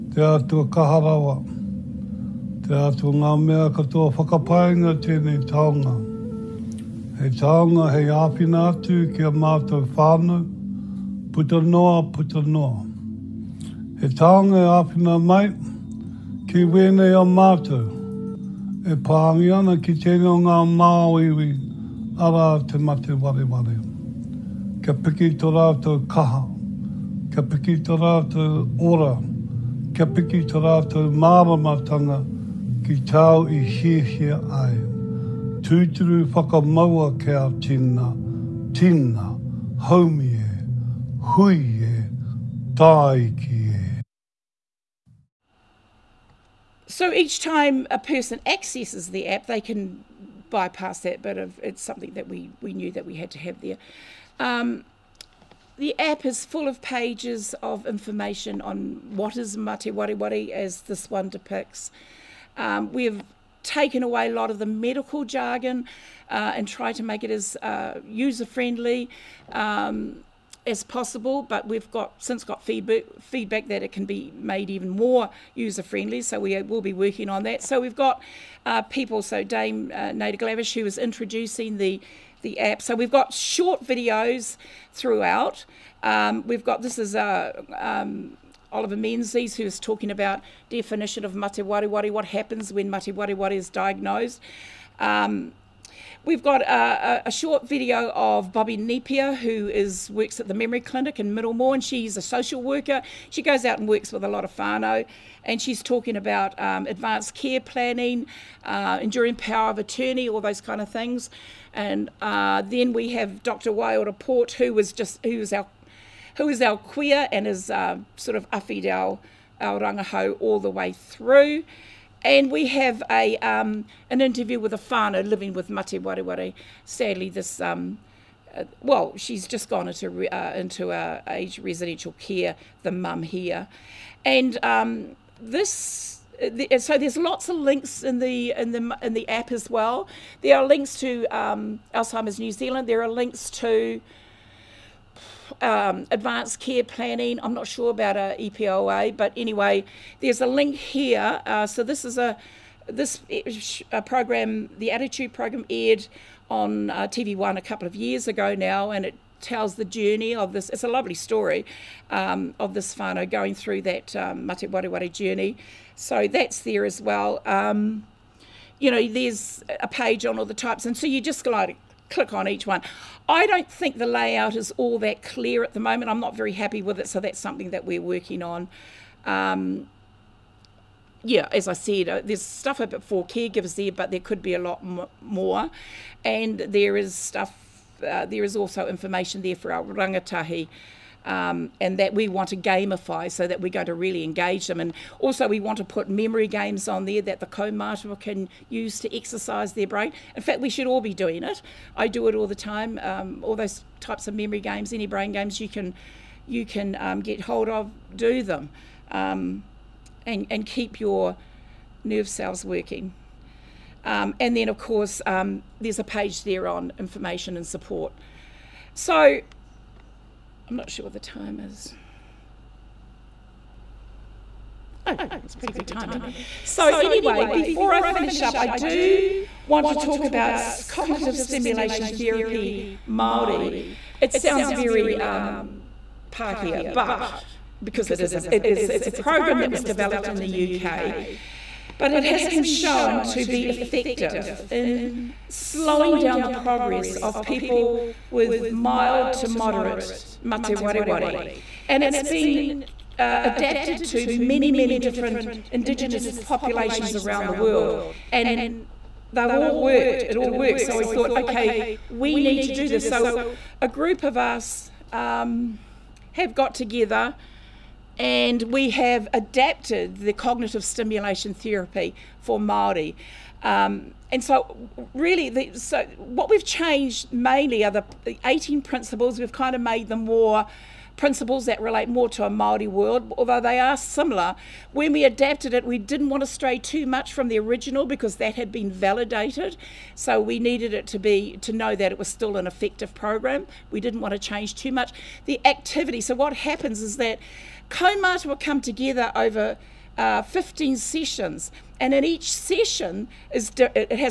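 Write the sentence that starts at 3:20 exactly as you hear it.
In fact, we should all be doing it.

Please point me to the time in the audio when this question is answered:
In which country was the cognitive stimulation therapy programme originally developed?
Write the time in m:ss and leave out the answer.
4:00.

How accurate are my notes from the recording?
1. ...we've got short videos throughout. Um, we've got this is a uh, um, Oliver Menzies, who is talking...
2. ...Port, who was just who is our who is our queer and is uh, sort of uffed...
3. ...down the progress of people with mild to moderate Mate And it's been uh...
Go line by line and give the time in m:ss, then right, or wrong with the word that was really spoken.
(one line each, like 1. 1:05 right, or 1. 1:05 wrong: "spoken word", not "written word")
1. 1:22 right
2. 1:54 right
3. 4:06 right.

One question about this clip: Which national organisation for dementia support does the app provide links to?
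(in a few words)
Alzheimer's New Zealand.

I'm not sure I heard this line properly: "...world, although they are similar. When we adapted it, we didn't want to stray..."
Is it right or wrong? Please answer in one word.
right.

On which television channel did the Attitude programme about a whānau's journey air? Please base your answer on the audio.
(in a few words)
TV1.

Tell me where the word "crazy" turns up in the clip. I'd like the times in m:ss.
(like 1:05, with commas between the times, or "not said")
not said.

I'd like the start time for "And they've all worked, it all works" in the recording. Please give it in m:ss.
4:18.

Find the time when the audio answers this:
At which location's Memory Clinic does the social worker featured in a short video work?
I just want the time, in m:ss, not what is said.
1:41.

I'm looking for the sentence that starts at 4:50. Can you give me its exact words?
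So we needed it to be to know that it was still an effective program.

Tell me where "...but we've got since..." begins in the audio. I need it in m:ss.
1:11.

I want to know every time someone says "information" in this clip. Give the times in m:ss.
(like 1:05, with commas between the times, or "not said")
0:57, 3:08, 3:36.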